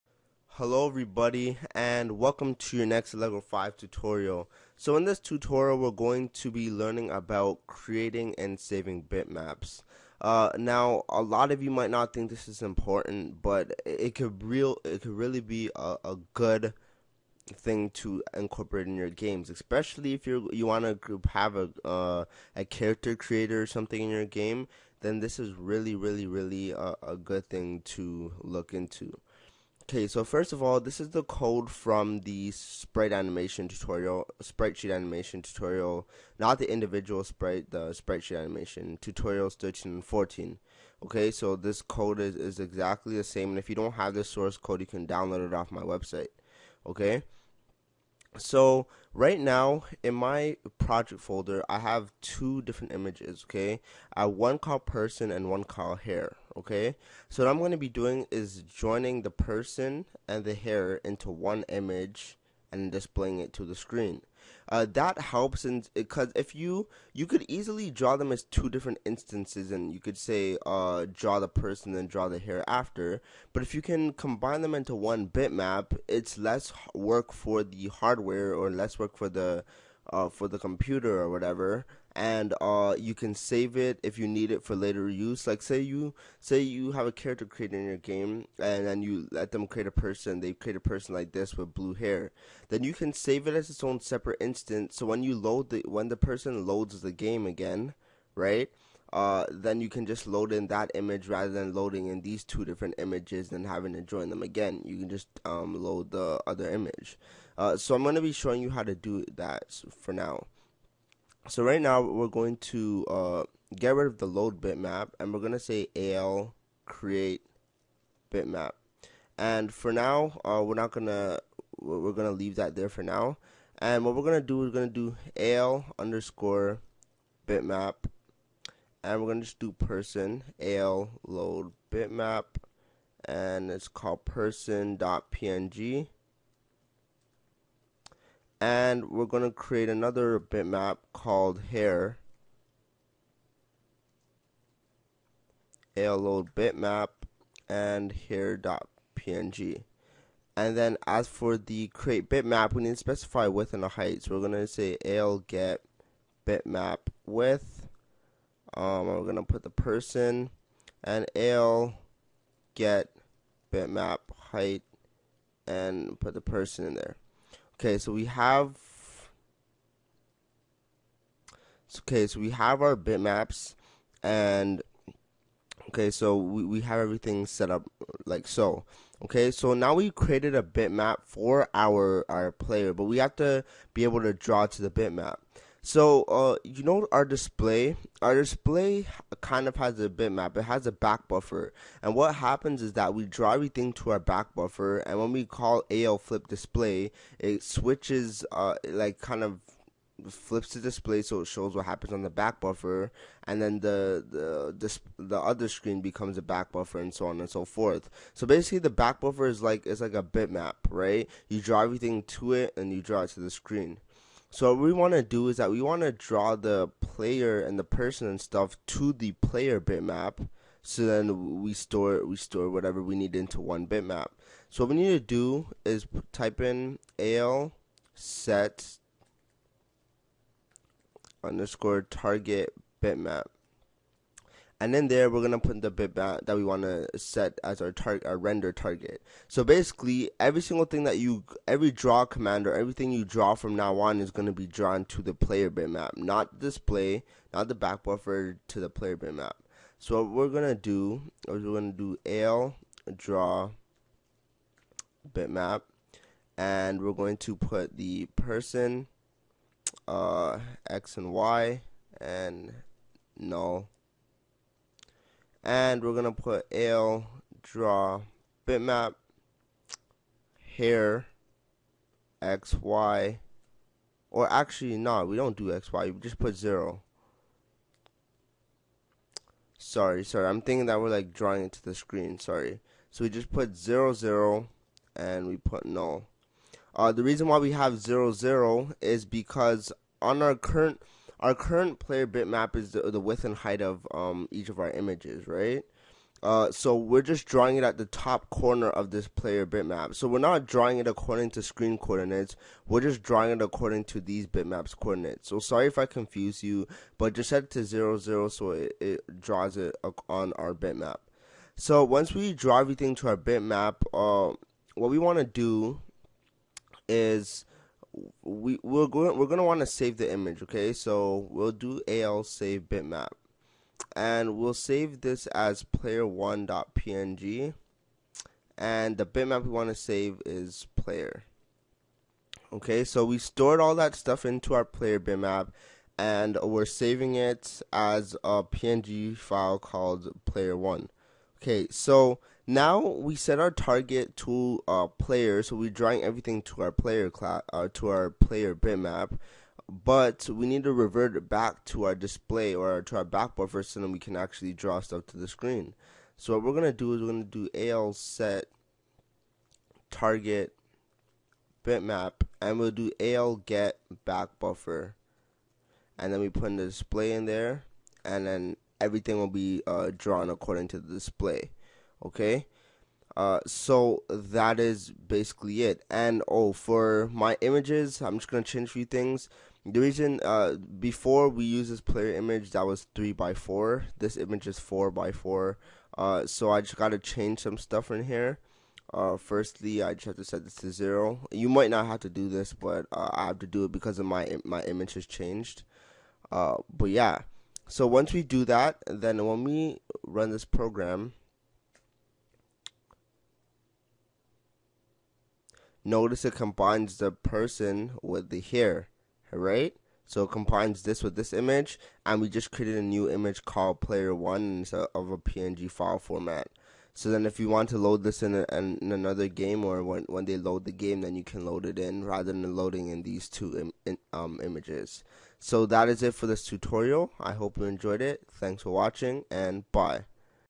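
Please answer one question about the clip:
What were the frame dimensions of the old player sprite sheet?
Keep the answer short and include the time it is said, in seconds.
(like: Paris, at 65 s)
3 by 4, at 383 s.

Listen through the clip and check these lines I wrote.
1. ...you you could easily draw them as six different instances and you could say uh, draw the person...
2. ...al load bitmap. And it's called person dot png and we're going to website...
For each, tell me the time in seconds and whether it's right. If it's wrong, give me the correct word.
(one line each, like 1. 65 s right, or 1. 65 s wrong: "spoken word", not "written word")
1. 66 s wrong: "two", not "six"
2. 130 s wrong: "create", not "website".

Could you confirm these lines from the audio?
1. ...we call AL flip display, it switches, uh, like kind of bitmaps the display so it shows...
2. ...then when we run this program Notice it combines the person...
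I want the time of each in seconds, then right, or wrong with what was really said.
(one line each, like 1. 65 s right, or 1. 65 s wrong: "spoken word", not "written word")
1. 195 s wrong: "flips", not "bitmaps"
2. 399 s right.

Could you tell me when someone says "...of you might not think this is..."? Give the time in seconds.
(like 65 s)
11 s.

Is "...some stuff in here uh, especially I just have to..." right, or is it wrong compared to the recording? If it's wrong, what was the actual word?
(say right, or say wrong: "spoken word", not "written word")
wrong: "firstly", not "especially".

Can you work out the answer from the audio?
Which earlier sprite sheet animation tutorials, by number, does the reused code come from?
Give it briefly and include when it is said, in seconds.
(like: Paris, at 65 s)
13 and 14, at 39 s.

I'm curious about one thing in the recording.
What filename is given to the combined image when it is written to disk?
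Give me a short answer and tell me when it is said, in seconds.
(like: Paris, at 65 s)
player1.png, at 325 s.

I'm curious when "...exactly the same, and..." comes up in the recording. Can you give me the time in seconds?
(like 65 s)
42 s.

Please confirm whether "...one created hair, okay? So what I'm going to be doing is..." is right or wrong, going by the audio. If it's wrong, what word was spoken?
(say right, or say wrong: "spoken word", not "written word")
wrong: "called", not "created".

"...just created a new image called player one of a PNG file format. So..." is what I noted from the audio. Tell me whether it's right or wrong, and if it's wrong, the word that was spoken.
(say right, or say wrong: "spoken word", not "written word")
right.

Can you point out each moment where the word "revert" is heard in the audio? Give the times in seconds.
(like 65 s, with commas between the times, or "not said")
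350 s.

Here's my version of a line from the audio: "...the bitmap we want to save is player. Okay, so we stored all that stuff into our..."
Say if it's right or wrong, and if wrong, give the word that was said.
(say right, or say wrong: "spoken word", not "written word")
right.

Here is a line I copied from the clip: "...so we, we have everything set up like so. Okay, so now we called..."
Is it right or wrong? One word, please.
wrong.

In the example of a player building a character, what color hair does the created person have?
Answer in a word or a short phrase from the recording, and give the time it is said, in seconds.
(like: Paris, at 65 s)
blue, at 91 s.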